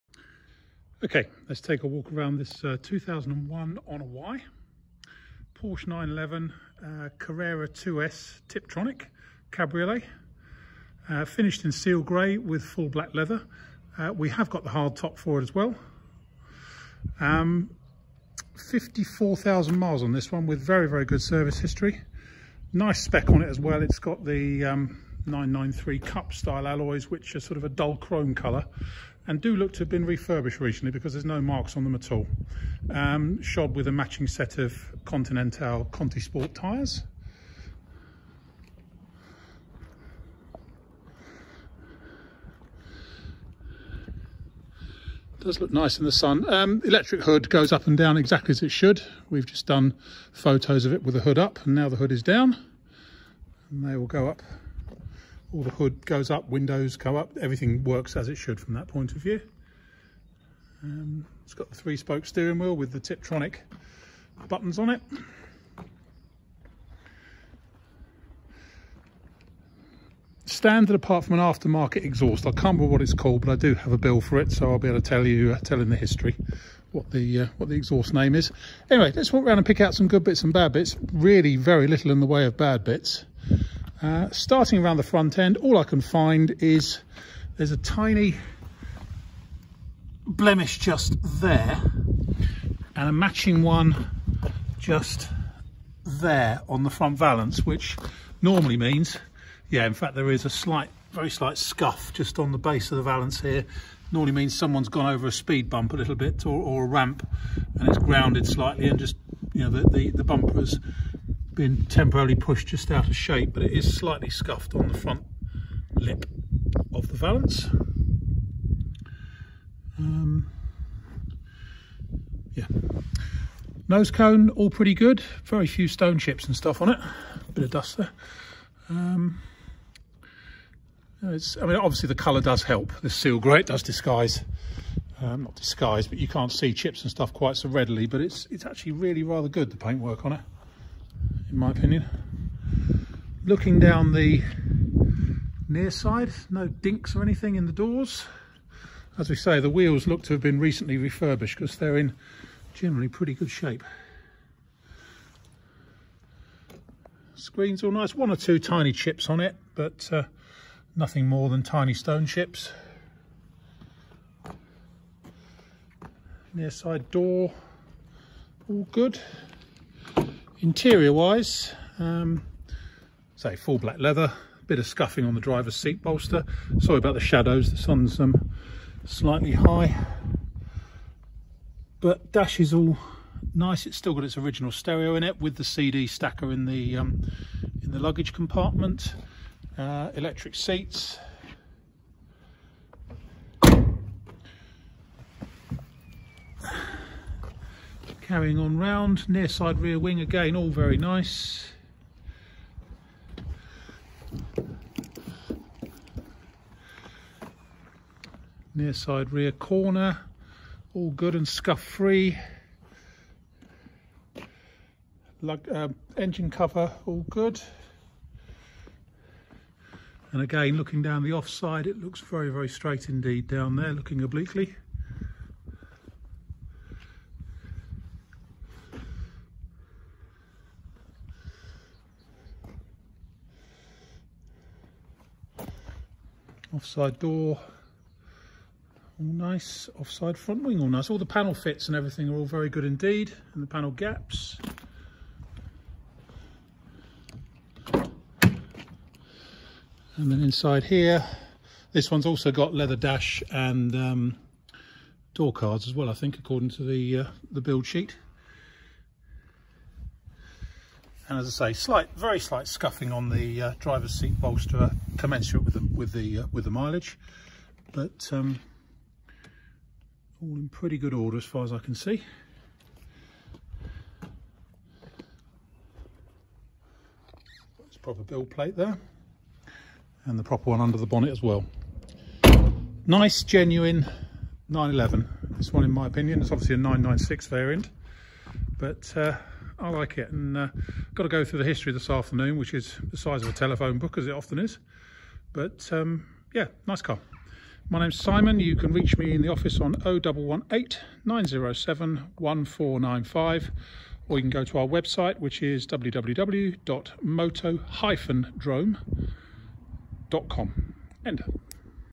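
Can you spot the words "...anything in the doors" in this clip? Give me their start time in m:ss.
2:27.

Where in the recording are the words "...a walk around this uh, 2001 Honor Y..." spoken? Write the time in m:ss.
0:01.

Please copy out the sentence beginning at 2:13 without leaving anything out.
The seal grey does disguise, um, not disguise, but you can't see chips and stuff quite so readily.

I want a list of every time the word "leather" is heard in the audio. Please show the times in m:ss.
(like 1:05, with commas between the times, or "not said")
0:13, 2:53, 4:12.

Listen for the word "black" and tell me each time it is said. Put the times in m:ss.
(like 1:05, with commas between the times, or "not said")
0:12, 2:53.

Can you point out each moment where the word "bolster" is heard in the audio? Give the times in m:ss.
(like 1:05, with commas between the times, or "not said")
2:56, 4:24.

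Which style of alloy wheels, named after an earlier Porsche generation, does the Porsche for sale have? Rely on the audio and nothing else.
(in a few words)
993 cup style.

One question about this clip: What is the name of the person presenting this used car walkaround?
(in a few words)
Simon.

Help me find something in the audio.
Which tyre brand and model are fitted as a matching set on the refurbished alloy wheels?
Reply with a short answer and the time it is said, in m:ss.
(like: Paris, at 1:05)
Continental Conti Sport, at 0:35.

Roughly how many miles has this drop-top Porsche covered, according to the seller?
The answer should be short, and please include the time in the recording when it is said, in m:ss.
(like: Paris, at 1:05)
54,000, at 0:18.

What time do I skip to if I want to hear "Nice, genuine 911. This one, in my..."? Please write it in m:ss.
4:43.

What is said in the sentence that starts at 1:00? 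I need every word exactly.
Um, it's got the three spoke steering wheel with the Tiptronic buttons on it.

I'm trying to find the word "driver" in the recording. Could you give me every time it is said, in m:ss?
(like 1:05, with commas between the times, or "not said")
2:55, 4:23.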